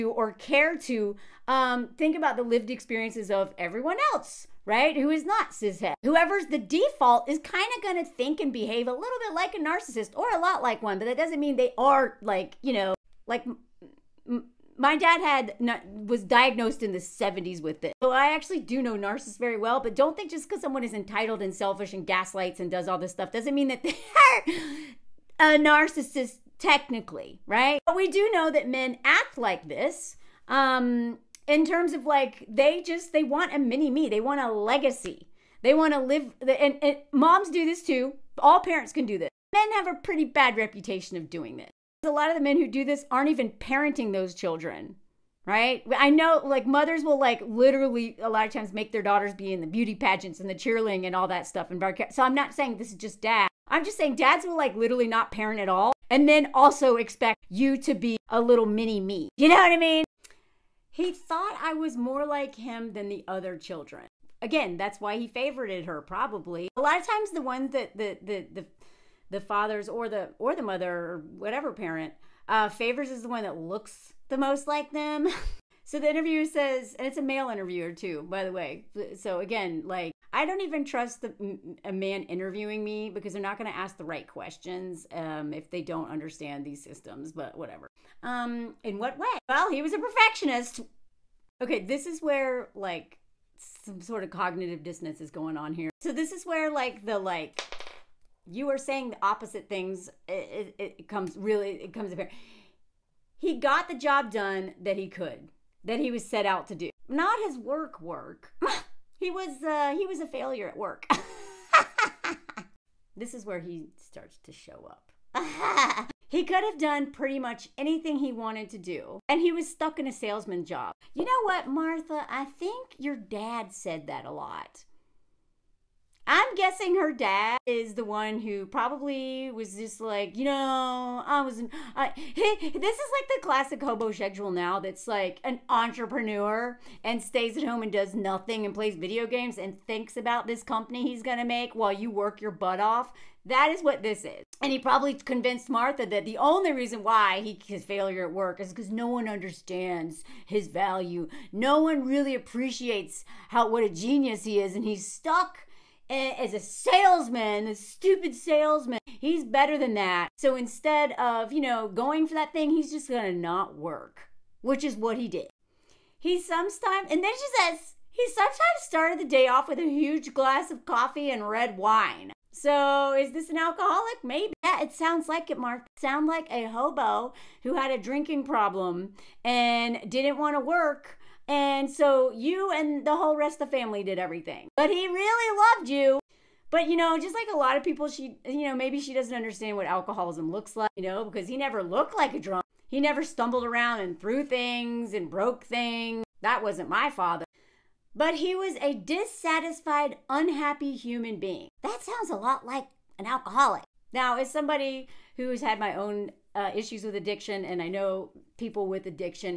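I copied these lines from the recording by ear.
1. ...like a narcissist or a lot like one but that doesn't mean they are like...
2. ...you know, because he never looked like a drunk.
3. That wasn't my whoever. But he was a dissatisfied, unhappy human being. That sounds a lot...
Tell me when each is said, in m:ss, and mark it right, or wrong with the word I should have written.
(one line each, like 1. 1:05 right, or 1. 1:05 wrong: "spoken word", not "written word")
1. 0:09 right
2. 3:10 right
3. 3:16 wrong: "father", not "whoever".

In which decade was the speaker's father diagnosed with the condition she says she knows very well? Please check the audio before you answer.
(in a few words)
the 70s.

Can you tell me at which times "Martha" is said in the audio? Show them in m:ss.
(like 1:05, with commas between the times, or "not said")
2:01, 2:25.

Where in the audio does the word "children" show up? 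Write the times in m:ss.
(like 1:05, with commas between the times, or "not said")
0:44, 1:03.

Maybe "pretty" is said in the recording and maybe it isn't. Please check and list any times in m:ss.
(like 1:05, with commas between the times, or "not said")
0:39, 1:57.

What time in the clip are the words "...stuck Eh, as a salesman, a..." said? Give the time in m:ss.
2:35.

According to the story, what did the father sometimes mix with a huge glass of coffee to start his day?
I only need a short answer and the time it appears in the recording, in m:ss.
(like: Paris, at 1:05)
red wine, at 2:51.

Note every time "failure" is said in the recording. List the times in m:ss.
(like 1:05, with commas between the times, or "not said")
1:50, 2:27.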